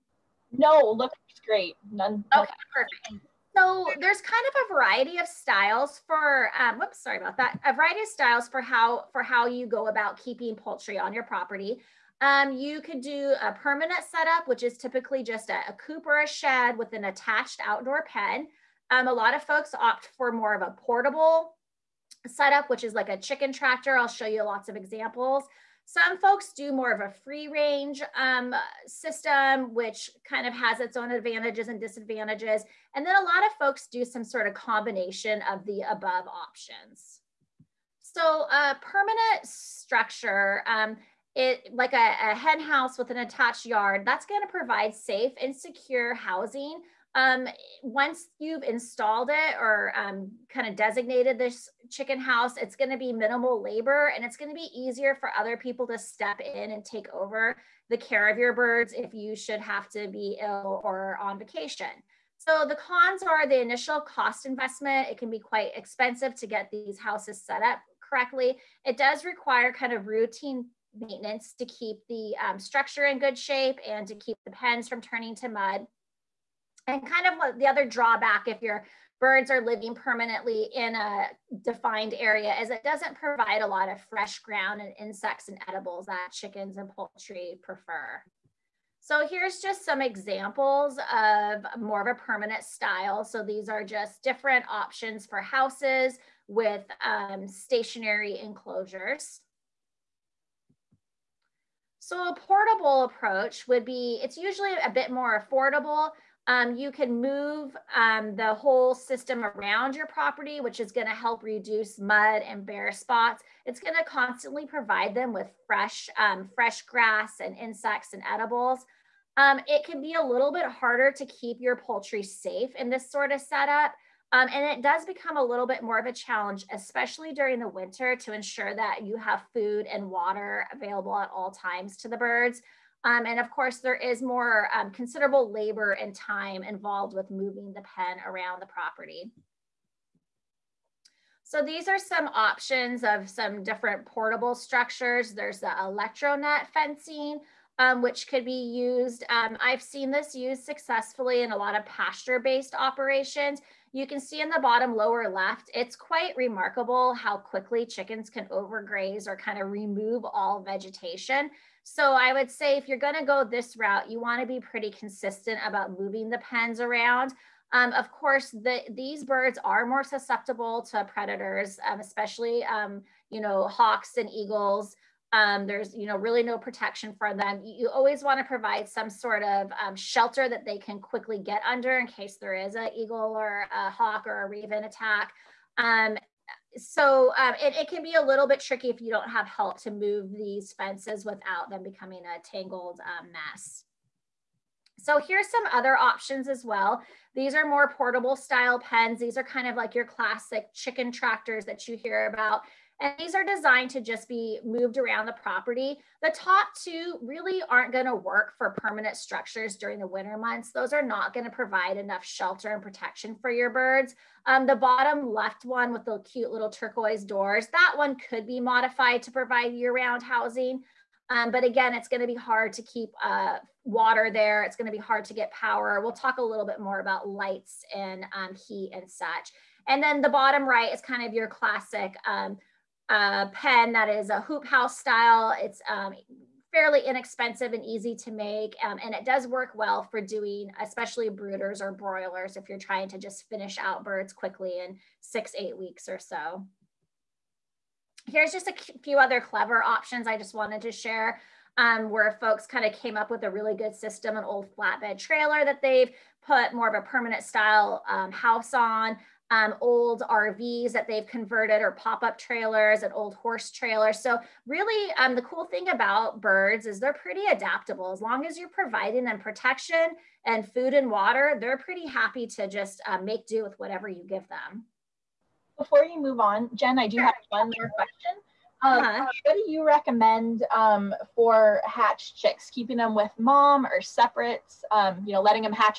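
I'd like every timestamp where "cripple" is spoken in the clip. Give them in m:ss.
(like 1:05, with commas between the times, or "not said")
not said.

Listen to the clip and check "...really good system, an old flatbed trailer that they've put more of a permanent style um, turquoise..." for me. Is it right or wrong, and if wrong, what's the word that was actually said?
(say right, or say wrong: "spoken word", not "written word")
wrong: "house", not "turquoise".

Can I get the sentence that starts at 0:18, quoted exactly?
Um, a lot of folks opt for more of a portable setup, which is like a chicken tractor.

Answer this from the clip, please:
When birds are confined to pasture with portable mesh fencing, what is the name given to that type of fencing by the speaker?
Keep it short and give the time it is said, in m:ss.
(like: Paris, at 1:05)
electronet fencing, at 2:25.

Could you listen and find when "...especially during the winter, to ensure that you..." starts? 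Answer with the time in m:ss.
2:06.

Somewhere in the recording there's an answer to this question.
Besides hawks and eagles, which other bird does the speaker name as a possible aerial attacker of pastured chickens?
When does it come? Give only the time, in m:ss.
3:04.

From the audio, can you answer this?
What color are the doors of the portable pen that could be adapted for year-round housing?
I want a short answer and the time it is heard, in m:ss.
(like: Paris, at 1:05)
turquoise, at 3:36.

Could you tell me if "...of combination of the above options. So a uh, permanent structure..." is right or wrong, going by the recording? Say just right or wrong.
right.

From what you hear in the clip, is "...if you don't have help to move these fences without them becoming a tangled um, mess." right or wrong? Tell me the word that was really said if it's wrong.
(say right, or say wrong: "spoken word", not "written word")
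right.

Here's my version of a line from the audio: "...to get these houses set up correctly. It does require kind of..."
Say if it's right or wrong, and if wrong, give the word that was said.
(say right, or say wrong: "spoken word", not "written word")
right.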